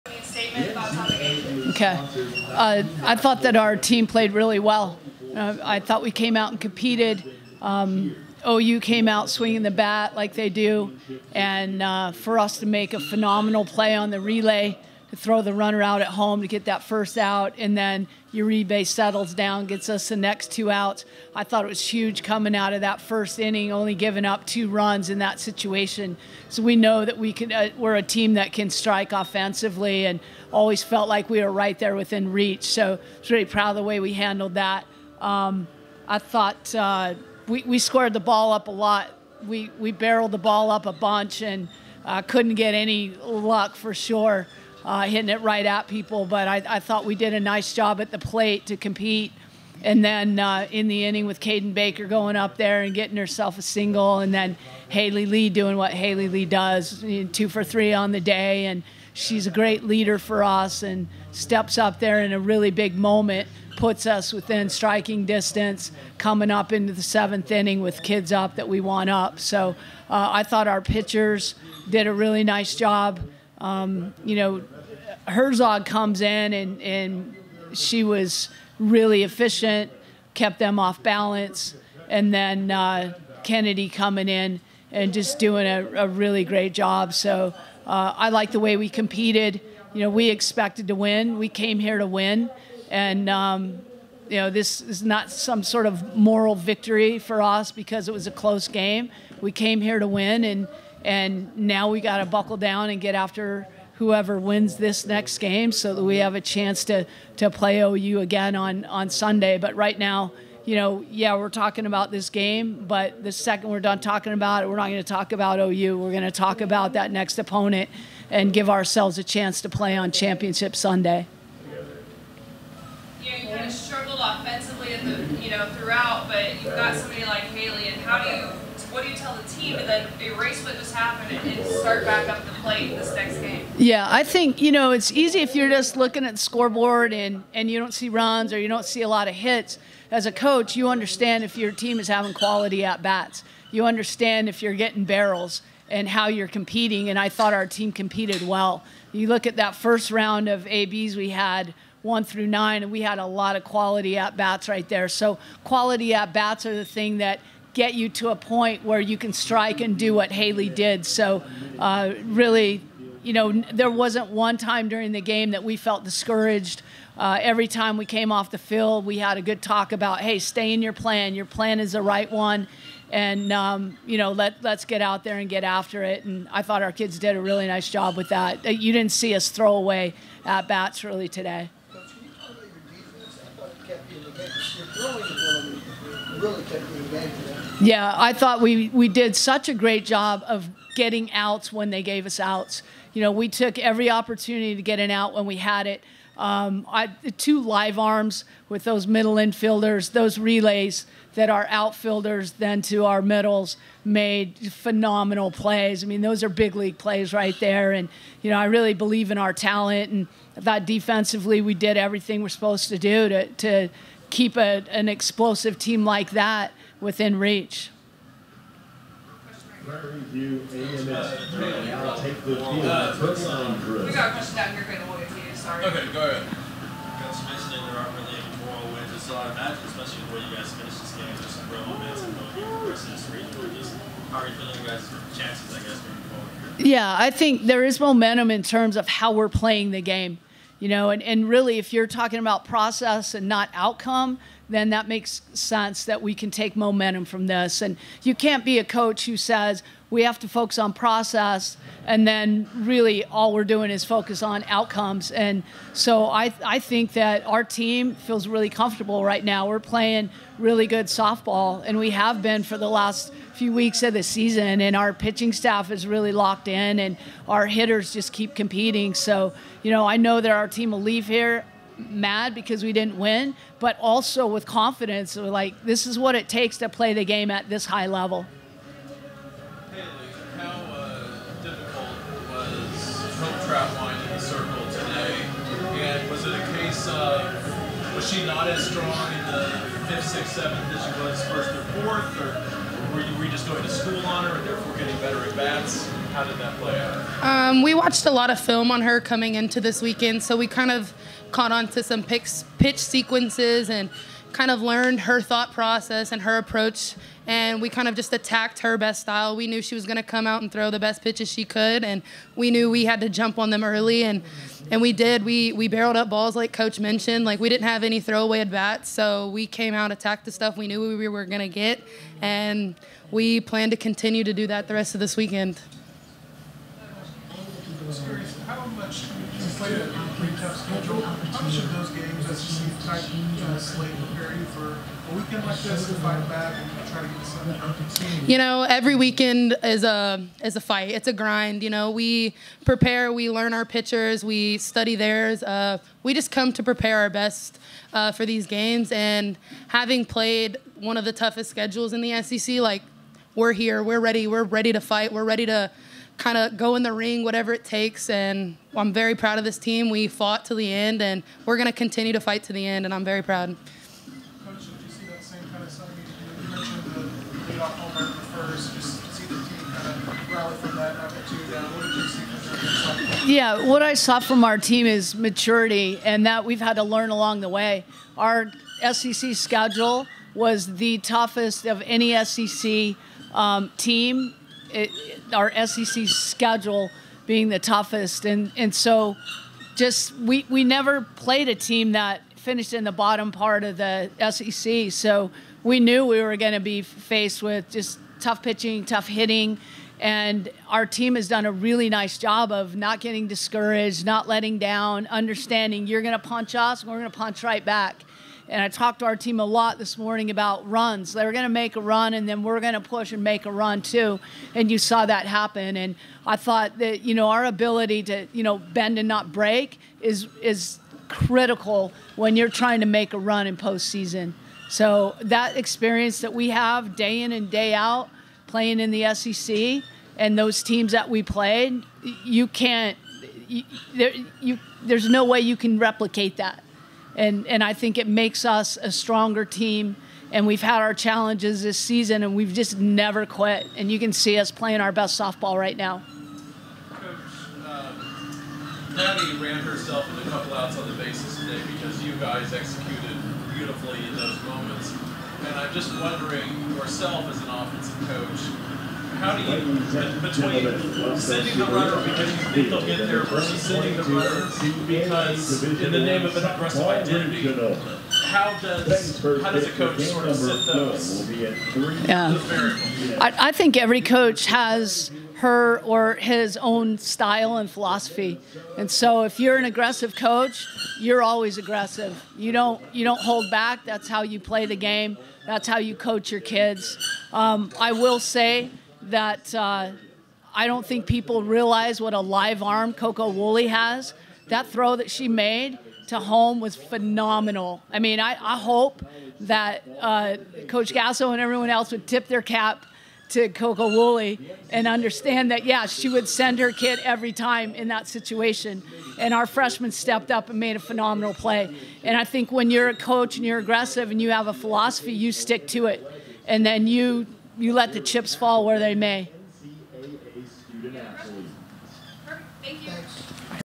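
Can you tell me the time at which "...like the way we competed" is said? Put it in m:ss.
1:28.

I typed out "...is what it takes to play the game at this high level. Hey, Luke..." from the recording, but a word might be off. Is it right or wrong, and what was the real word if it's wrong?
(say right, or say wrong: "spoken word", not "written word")
right.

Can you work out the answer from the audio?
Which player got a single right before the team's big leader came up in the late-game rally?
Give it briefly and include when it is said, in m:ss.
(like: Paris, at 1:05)
Caden Baker, at 0:51.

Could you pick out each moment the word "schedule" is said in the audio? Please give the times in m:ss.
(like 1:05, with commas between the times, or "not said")
5:30, 5:51, 6:19, 6:26.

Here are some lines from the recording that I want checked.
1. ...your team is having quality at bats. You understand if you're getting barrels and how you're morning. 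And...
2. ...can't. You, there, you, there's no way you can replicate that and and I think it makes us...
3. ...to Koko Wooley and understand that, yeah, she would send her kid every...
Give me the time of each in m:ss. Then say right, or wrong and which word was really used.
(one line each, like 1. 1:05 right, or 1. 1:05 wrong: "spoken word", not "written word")
1. 2:21 wrong: "competing", not "morning"
2. 7:12 right
3. 8:23 right.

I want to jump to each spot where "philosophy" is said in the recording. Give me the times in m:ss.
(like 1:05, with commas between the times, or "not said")
7:57, 8:34.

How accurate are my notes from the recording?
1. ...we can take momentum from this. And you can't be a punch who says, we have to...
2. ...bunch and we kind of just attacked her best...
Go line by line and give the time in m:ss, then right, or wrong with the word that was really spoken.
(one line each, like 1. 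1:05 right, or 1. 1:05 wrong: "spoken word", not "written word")
1. 4:06 wrong: "coach", not "punch"
2. 5:06 wrong: "approach", not "bunch".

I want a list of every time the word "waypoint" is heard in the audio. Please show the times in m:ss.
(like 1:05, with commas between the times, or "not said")
not said.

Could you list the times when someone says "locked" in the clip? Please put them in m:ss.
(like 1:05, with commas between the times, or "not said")
4:26.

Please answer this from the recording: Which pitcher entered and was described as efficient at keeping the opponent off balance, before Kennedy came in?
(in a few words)
Herzog.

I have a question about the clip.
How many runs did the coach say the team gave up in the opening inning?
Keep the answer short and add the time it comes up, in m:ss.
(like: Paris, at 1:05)
2, at 0:24.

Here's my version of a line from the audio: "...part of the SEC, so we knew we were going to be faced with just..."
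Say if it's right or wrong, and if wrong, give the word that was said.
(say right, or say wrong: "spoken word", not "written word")
right.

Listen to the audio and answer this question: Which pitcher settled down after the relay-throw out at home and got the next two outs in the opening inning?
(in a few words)
Uribe.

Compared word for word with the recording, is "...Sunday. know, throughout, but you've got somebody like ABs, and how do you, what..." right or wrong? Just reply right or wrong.
wrong.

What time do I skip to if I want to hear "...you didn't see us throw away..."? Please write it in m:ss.
2:58.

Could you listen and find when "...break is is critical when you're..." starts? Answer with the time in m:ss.
6:59.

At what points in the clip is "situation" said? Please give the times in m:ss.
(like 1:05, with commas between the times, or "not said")
0:25, 8:28.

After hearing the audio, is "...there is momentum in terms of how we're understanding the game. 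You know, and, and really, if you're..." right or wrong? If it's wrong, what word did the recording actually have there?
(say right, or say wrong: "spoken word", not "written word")
wrong: "playing", not "understanding".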